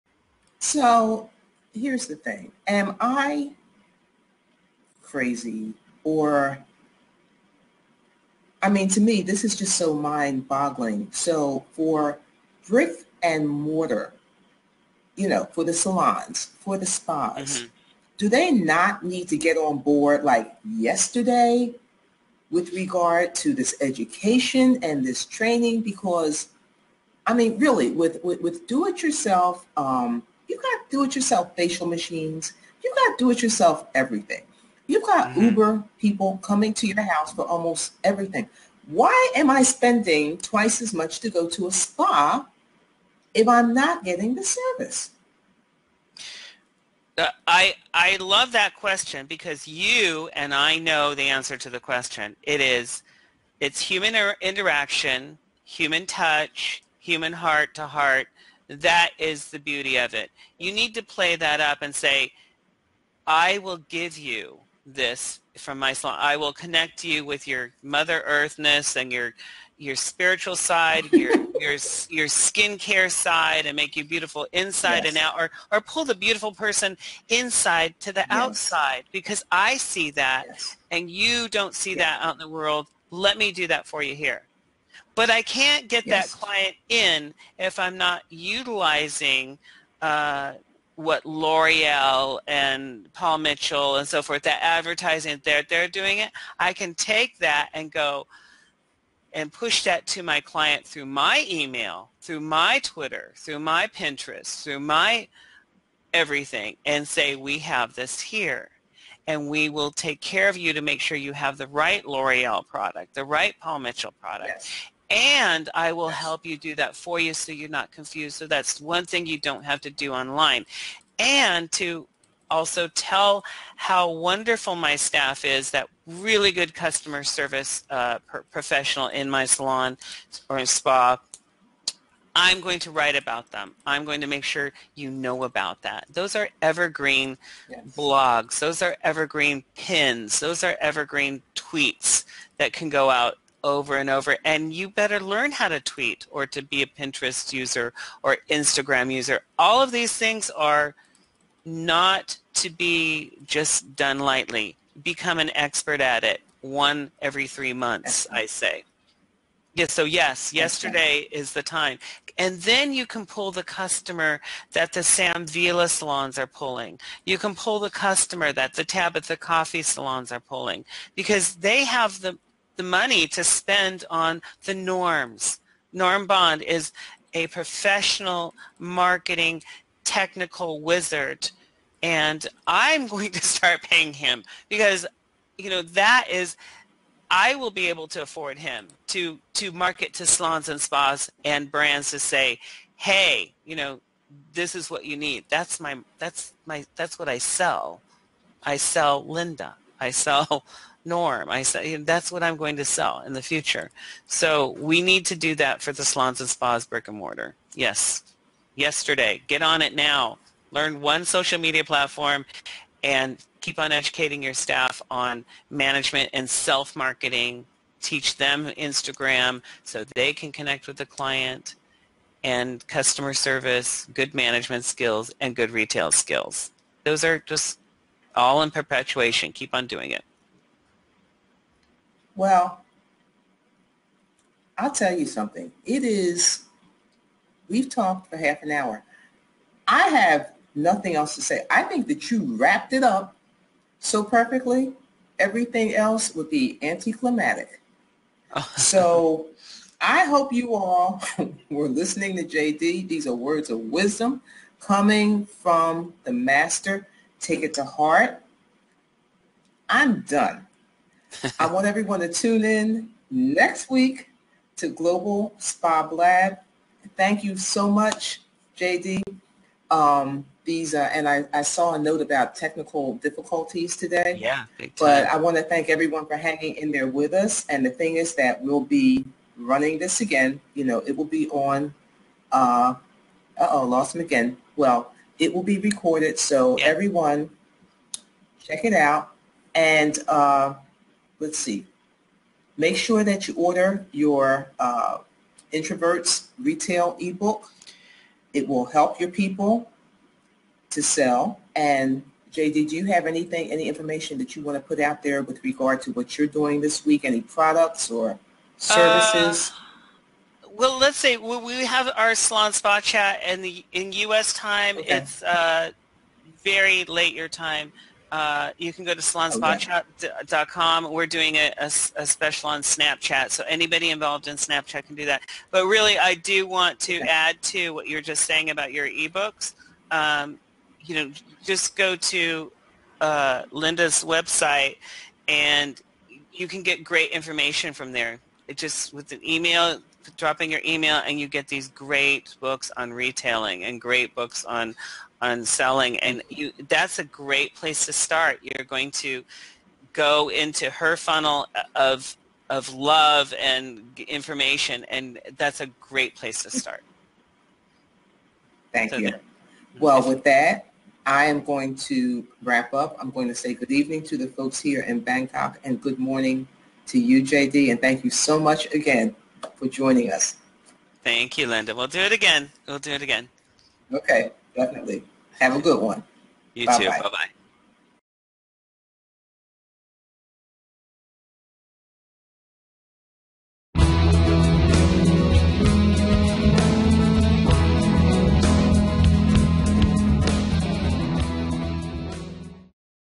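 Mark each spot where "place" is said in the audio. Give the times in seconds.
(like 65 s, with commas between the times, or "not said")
347 s, 356 s.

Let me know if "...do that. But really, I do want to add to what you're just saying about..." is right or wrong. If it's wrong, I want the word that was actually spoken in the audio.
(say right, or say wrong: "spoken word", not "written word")
right.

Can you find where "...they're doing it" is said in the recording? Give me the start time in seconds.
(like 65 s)
95 s.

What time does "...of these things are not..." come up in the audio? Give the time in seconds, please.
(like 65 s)
149 s.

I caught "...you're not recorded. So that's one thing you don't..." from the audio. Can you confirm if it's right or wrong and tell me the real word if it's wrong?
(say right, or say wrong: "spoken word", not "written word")
wrong: "confused", not "recorded".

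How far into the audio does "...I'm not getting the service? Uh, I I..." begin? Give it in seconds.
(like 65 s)
43 s.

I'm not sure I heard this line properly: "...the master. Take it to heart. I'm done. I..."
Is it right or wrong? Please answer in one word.
right.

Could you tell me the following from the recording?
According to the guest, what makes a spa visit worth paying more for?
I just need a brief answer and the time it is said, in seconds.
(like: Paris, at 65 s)
Human interaction, at 53 s.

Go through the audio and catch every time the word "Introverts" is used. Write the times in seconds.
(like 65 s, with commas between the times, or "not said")
295 s.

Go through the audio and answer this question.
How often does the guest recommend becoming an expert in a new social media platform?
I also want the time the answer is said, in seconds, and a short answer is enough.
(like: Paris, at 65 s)
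Every three months, at 157 s.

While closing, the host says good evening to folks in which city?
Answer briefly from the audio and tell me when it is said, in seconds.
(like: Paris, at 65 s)
Bangkok, at 365 s.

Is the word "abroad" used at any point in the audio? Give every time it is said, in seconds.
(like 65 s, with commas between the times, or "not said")
not said.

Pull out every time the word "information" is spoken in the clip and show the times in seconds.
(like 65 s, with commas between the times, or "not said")
303 s, 337 s, 354 s.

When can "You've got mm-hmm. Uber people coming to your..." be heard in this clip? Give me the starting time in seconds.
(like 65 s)
34 s.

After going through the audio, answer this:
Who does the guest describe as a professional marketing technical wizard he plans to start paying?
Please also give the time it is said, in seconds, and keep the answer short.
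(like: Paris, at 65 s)
Norm Bond, at 175 s.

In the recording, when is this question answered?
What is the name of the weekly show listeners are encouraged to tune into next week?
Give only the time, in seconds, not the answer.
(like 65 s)
264 s.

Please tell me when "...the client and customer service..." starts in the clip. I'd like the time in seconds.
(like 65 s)
220 s.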